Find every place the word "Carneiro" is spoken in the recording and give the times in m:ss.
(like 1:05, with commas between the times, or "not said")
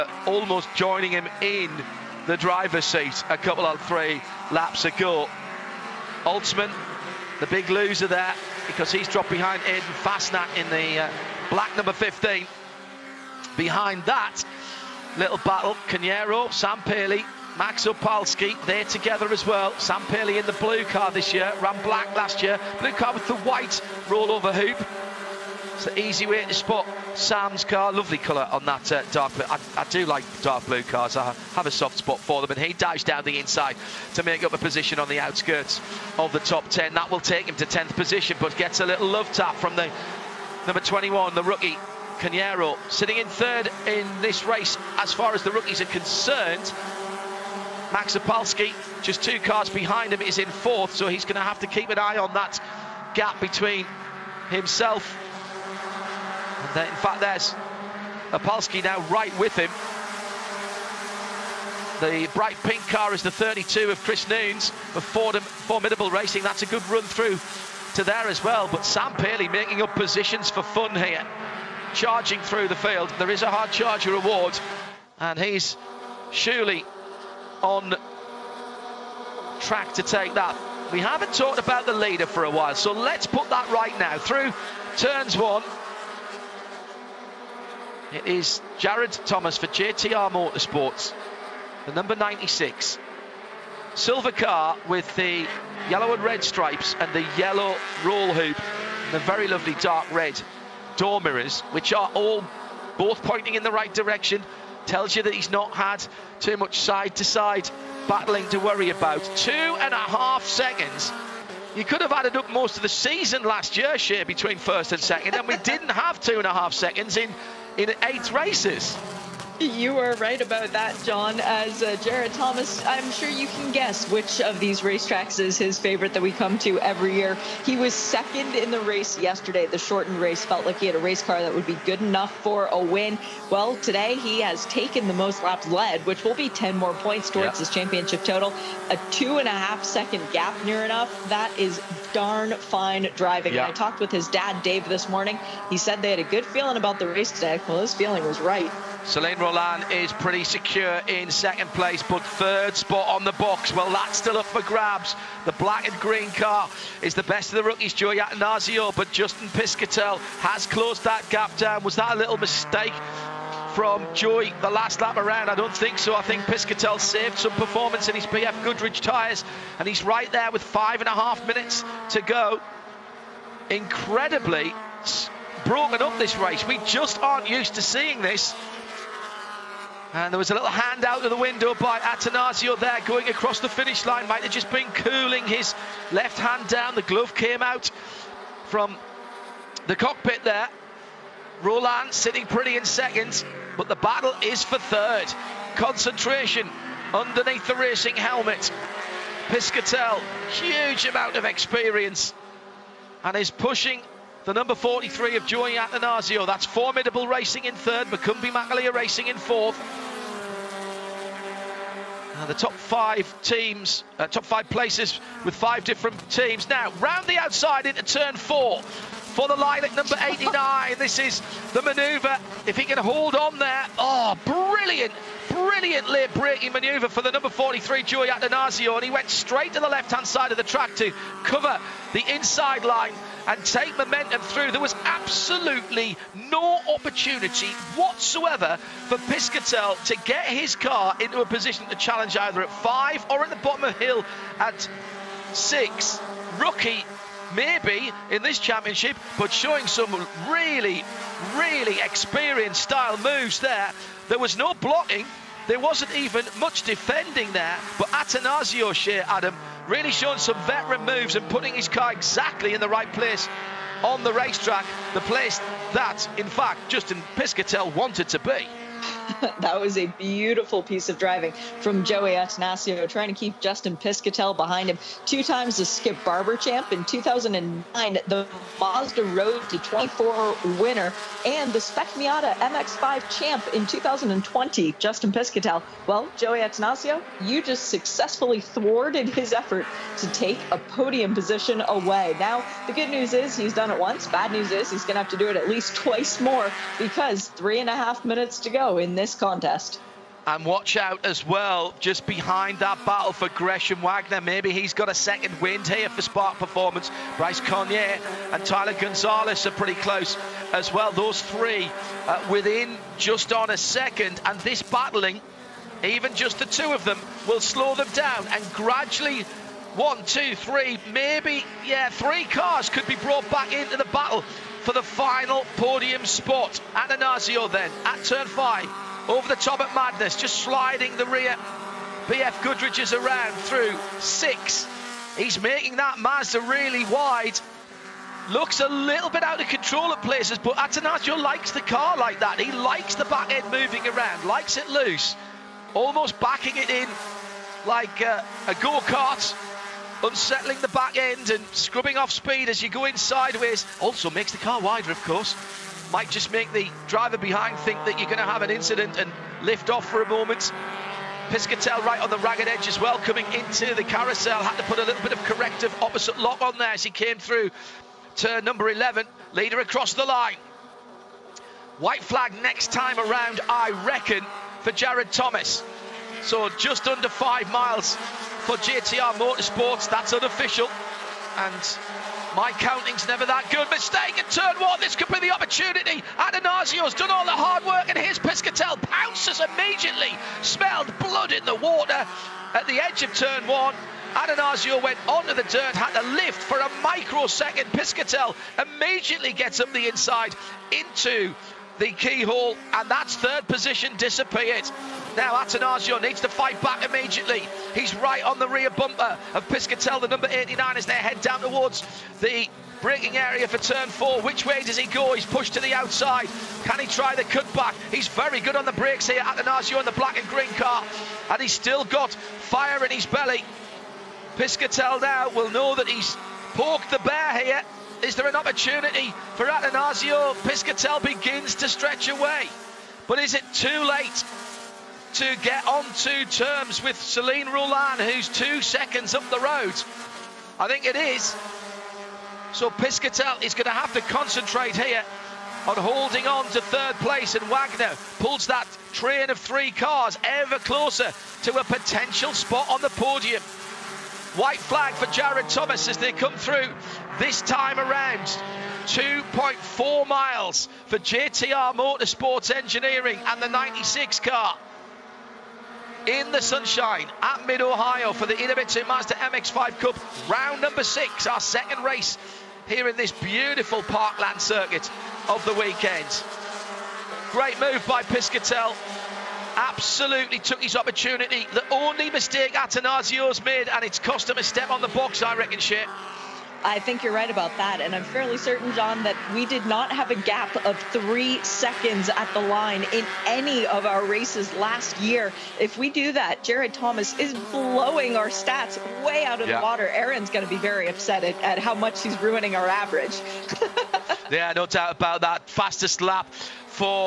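0:15, 0:42.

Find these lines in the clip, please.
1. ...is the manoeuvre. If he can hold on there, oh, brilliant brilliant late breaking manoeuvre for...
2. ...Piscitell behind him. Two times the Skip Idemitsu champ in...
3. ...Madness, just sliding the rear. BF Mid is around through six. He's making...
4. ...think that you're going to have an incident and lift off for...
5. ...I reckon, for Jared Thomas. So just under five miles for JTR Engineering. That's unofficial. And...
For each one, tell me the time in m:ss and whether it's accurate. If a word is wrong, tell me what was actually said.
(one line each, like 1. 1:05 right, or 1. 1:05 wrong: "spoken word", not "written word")
1. 3:41 right
2. 4:33 wrong: "Barber", not "Idemitsu"
3. 5:29 wrong: "Goodrich", not "Mid"
4. 5:57 right
5. 6:13 wrong: "Motorsports", not "Engineering".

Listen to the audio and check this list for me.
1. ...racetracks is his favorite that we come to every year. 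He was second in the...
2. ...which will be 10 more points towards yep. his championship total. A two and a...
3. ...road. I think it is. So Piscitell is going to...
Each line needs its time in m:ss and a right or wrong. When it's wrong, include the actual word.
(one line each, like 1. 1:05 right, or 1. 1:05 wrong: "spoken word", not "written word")
1. 2:04 right
2. 2:16 right
3. 7:19 right.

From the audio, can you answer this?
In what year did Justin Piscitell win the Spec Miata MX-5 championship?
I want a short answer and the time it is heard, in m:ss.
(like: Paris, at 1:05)
2020, at 4:43.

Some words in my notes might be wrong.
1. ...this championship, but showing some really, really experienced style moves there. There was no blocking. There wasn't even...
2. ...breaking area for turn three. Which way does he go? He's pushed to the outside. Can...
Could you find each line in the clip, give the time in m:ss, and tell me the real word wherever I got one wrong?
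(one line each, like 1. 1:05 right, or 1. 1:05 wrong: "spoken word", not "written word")
1. 4:08 right
2. 6:53 wrong: "four", not "three".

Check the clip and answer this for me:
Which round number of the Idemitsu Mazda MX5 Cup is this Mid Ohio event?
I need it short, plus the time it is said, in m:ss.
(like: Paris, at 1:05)
6, at 7:50.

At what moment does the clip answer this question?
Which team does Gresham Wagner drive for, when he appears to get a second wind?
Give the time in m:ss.
5:06.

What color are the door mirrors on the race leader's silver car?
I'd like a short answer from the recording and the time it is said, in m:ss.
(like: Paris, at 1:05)
Dark red, at 1:39.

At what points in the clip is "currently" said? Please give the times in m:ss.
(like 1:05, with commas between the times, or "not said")
not said.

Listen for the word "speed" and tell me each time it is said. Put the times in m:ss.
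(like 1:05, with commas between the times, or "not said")
5:52.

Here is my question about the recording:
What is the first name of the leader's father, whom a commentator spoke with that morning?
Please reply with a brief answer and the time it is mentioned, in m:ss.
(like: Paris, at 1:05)
Dave, at 2:24.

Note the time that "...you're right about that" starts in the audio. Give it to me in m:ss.
8:07.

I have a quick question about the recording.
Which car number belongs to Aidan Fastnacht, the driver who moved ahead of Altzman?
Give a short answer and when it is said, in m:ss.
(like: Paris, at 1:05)
15, at 0:11.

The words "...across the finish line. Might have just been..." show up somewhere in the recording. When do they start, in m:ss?
3:03.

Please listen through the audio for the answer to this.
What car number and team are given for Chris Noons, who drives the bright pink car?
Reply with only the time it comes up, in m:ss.
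1:03.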